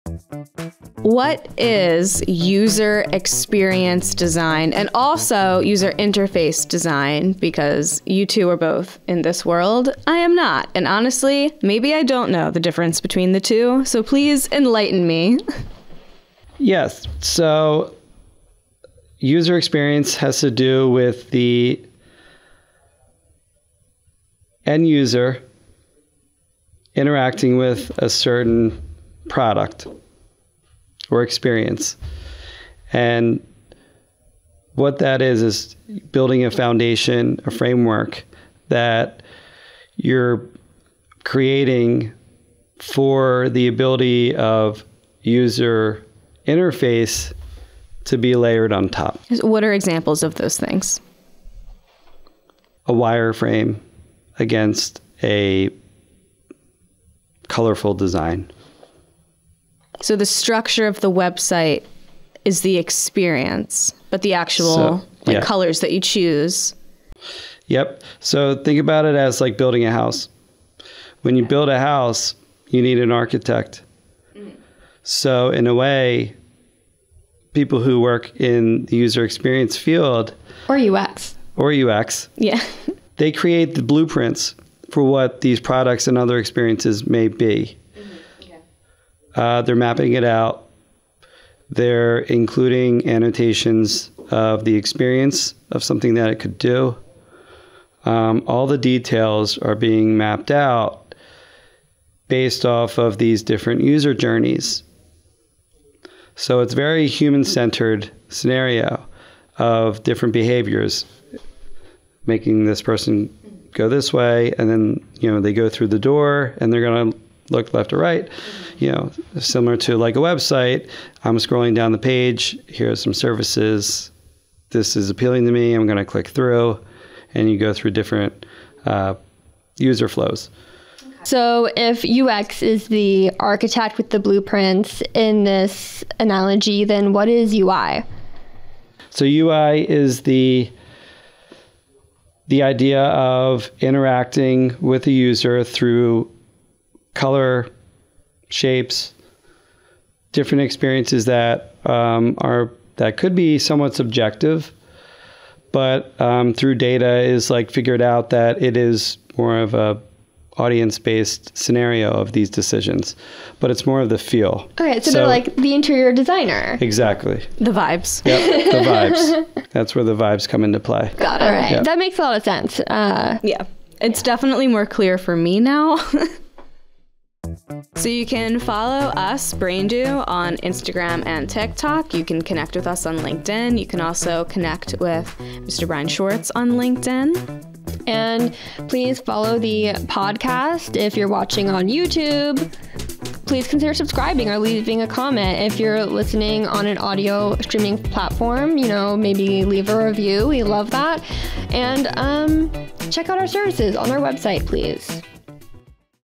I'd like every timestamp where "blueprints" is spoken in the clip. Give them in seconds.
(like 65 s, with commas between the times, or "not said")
83 s, 134 s.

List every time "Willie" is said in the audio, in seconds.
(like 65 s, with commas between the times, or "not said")
not said.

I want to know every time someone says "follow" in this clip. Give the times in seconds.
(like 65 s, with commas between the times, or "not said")
178 s, 189 s.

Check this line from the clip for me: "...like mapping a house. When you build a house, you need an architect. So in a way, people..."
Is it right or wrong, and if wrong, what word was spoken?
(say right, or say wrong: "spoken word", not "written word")
wrong: "building", not "mapping".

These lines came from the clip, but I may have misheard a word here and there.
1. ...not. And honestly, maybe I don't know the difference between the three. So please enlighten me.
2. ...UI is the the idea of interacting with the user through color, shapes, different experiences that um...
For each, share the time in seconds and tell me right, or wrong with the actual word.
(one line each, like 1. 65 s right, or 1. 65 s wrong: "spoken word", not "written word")
1. 10 s wrong: "two", not "three"
2. 139 s right.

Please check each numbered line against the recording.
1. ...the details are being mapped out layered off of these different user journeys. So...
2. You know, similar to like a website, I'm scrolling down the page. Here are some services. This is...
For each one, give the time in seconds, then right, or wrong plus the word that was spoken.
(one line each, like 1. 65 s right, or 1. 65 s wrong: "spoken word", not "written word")
1. 98 s wrong: "based", not "layered"
2. 118 s right.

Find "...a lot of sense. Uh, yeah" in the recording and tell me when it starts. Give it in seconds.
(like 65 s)
172 s.